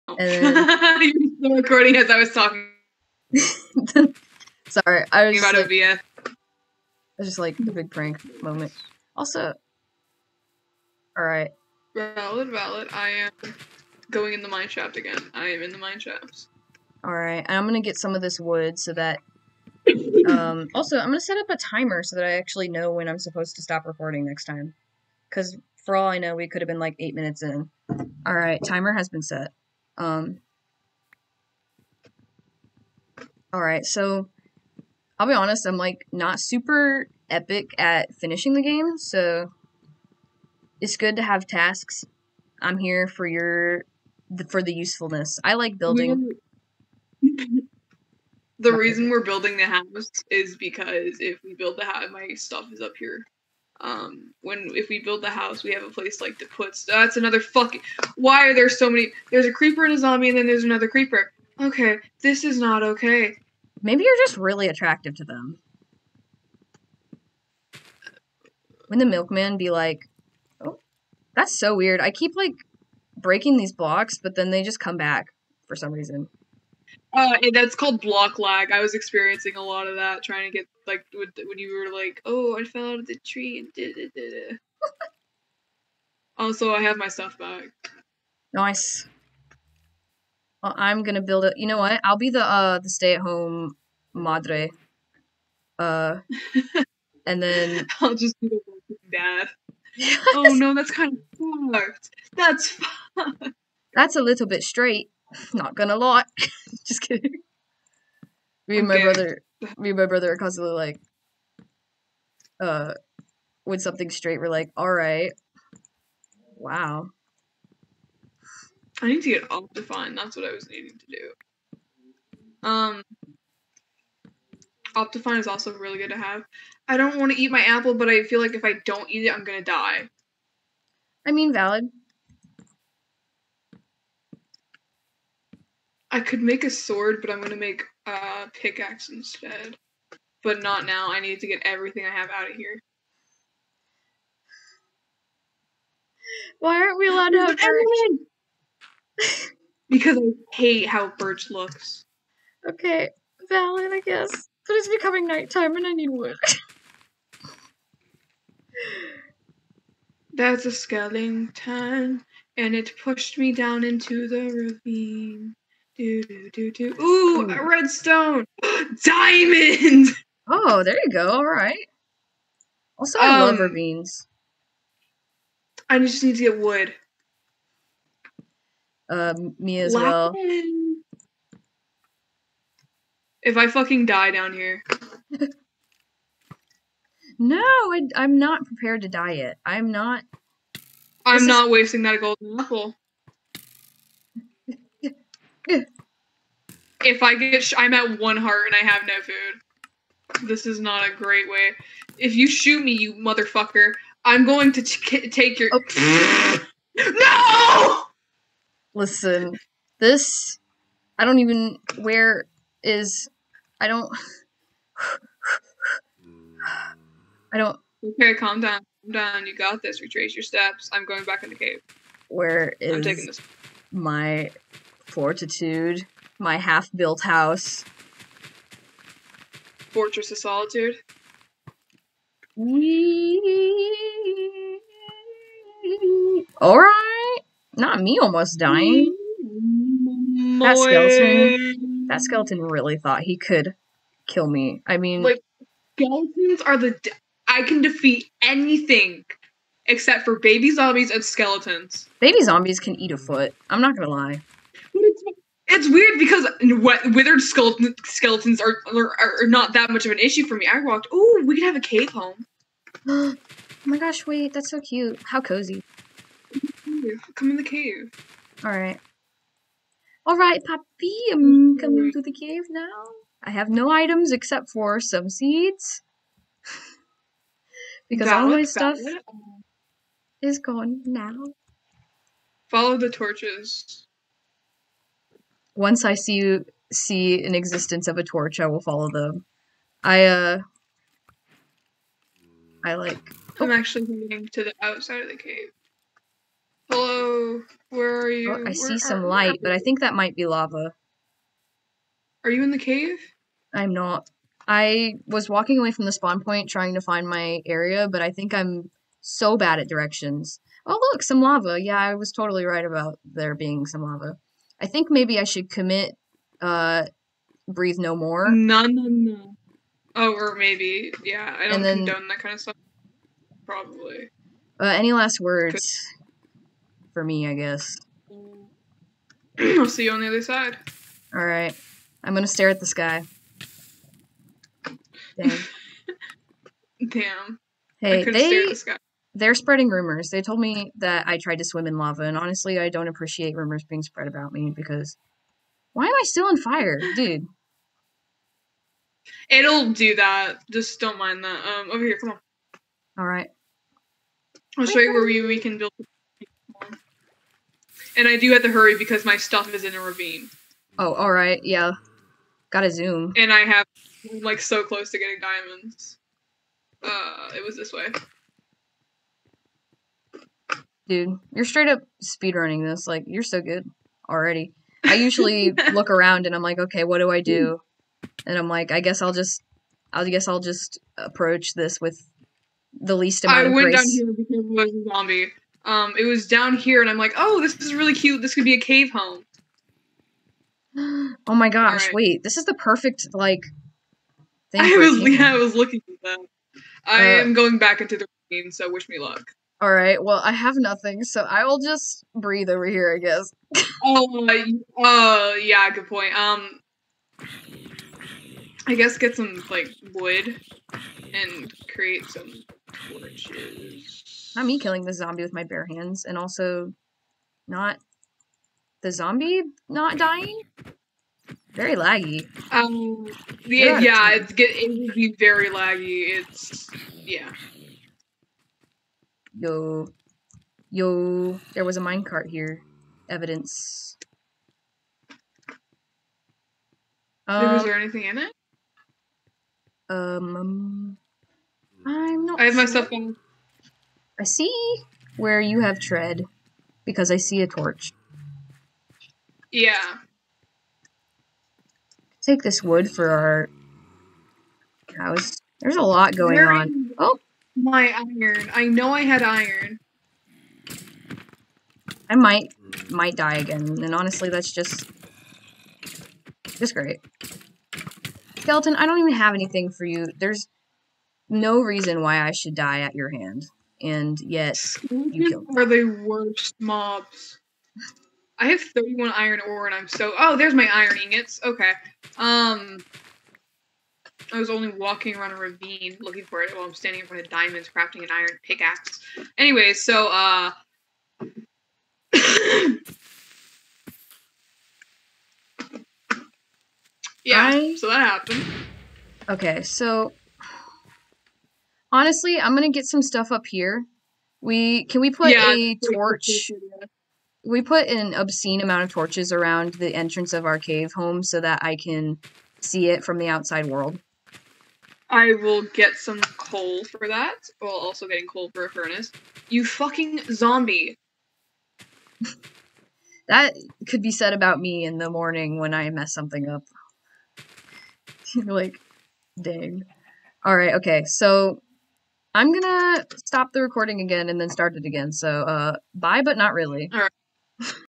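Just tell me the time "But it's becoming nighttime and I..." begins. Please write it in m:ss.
2:34.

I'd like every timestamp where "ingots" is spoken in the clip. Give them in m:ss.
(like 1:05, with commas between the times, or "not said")
8:01.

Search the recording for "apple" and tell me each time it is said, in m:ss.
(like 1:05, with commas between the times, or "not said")
2:07, 3:12.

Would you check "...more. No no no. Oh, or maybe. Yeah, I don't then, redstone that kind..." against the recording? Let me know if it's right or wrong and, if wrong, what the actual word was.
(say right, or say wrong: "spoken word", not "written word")
wrong: "condone", not "redstone".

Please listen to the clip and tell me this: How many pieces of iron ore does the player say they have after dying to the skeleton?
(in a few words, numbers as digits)
31.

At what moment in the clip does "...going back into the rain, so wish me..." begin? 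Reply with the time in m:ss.
6:37.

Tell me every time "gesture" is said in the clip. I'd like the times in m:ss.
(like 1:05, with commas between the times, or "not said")
not said.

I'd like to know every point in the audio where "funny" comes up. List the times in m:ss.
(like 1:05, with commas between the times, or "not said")
not said.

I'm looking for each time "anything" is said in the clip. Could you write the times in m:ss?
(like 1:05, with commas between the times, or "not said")
4:08, 7:17, 7:49.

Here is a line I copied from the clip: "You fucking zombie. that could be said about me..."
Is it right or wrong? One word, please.
right.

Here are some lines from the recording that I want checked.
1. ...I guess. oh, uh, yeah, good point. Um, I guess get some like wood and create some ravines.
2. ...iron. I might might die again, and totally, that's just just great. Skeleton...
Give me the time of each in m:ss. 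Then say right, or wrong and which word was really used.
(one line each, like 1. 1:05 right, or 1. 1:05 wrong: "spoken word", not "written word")
1. 6:43 wrong: "torches", not "ravines"
2. 7:39 wrong: "honestly", not "totally".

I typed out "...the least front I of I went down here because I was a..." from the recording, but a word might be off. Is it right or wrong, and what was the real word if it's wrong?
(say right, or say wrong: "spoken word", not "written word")
wrong: "amount", not "front".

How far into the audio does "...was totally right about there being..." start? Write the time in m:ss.
5:12.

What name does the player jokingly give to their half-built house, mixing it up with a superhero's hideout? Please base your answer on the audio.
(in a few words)
Fortitude.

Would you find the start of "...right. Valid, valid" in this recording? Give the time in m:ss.
0:11.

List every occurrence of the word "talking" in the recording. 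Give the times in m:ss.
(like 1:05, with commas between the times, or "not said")
0:02.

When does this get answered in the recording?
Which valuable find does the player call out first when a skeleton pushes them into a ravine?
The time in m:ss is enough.
2:47.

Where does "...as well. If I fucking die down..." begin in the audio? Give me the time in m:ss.
2:59.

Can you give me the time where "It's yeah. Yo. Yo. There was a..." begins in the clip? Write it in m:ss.
7:06.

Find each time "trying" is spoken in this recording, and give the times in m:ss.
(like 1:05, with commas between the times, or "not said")
1:20, 5:06.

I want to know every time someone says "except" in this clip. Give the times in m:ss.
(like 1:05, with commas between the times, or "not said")
4:09, 4:34.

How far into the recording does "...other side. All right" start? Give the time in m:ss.
5:30.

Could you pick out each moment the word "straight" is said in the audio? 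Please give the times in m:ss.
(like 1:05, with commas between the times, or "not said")
1:44, 1:54, 6:11.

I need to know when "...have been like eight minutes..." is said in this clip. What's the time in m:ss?
0:26.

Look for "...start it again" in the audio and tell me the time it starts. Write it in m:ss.
8:54.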